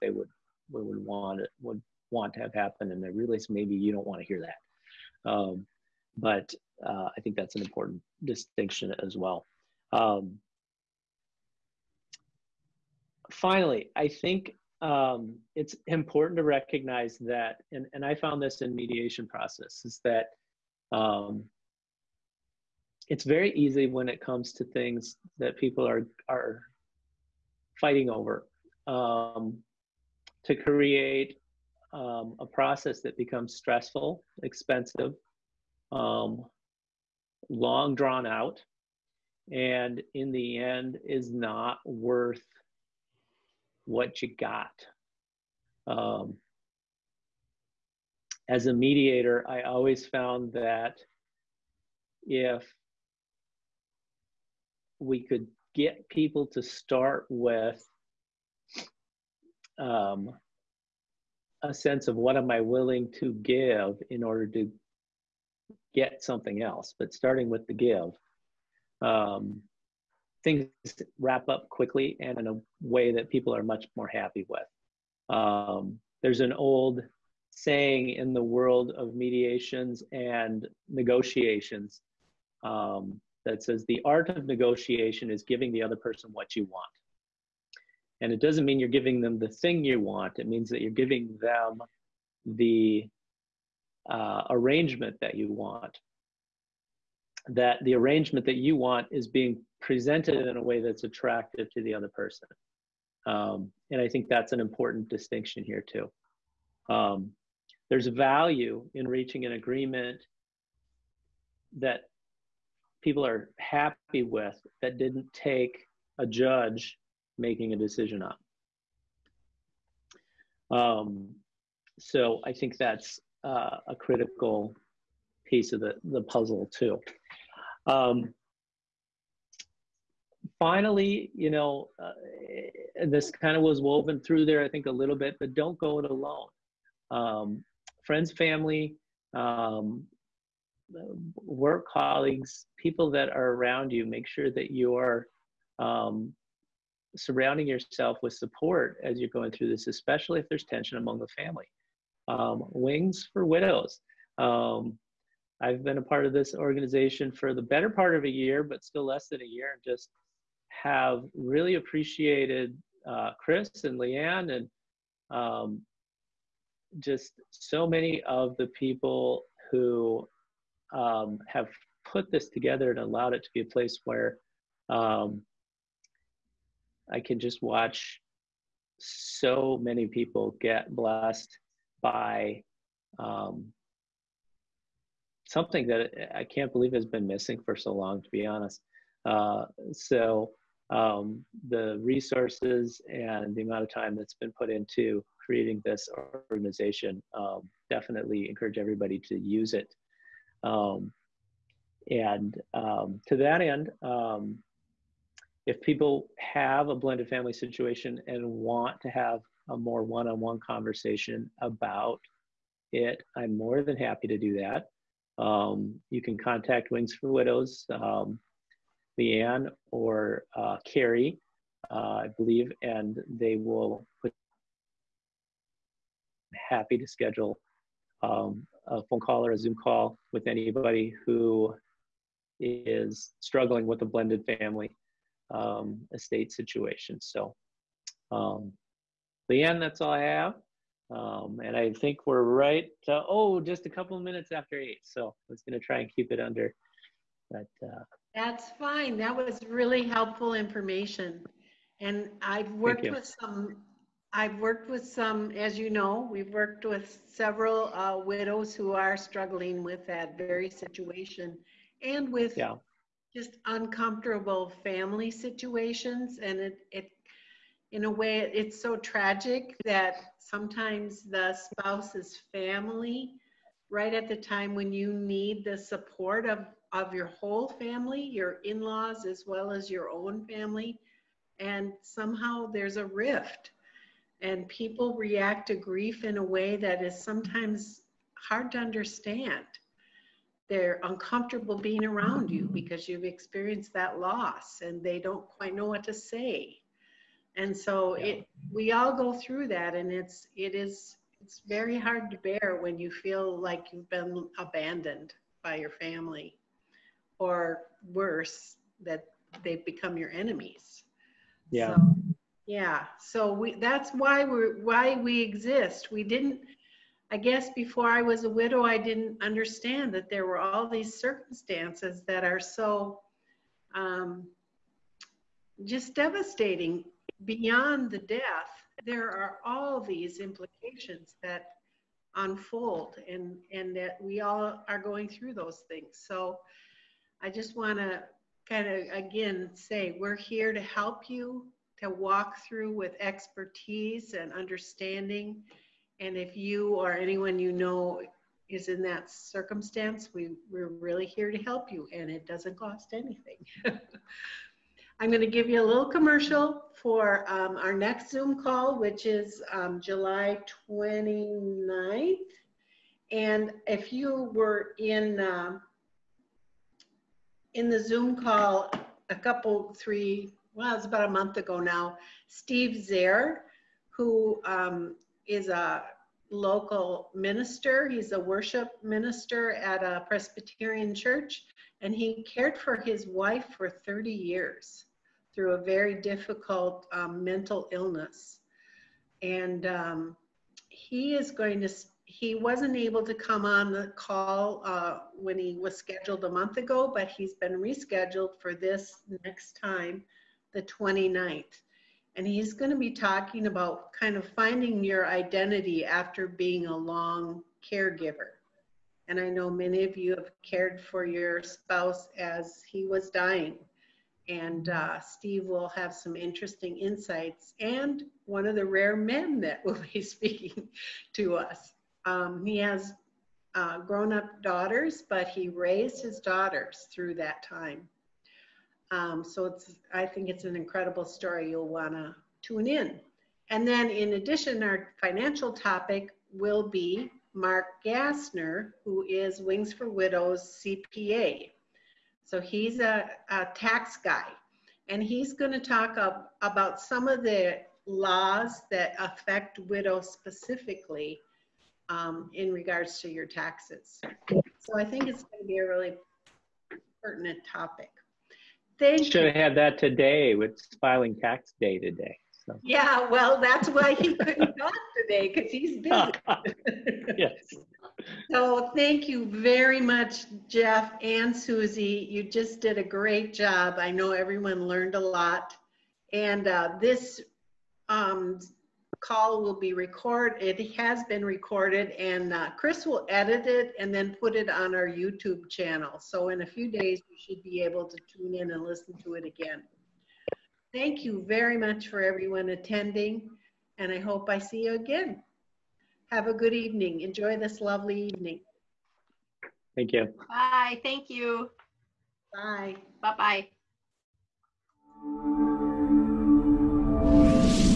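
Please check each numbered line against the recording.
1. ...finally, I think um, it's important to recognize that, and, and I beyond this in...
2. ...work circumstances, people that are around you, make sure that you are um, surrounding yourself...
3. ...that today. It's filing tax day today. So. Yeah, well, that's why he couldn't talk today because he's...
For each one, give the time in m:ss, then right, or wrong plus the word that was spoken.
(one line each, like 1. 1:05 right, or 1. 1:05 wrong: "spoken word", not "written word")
1. 0:13 wrong: "found", not "beyond"
2. 2:21 wrong: "colleagues", not "circumstances"
3. 7:39 right.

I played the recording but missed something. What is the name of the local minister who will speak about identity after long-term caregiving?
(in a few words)
Steve Zaire.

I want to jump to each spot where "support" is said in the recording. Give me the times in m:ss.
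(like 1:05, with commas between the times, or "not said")
2:28, 4:35.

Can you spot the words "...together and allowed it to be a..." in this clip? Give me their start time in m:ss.
2:52.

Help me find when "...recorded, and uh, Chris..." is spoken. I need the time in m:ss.
8:01.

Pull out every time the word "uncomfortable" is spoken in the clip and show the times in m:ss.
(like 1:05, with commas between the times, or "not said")
4:23, 4:51.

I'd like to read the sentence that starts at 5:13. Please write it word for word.
So we that's why we're why we exist.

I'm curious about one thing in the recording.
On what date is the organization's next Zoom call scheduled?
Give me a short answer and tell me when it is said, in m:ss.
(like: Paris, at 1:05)
July 29th, at 5:59.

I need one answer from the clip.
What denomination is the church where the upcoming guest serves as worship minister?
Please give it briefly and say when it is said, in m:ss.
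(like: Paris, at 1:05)
Presbyterian, at 6:20.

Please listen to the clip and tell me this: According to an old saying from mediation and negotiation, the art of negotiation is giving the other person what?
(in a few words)
what you want.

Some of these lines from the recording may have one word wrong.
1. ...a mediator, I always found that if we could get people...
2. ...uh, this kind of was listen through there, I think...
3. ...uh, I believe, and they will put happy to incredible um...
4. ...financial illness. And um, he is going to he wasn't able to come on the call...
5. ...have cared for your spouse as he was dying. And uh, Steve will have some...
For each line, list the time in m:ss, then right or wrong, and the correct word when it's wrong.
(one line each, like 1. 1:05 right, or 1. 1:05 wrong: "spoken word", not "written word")
1. 0:48 right
2. 2:12 wrong: "woven", not "listen"
3. 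3:41 wrong: "schedule", not "incredible"
4. 6:27 wrong: "mental", not "financial"
5. 6:50 right.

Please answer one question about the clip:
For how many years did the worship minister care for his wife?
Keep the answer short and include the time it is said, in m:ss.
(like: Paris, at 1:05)
30, at 6:23.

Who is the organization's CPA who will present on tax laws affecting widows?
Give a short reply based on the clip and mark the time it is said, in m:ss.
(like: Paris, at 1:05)
Mark Gassner, at 7:17.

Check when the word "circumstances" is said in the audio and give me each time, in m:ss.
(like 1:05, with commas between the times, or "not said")
5:21, 5:49.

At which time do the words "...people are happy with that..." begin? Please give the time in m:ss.
1:53.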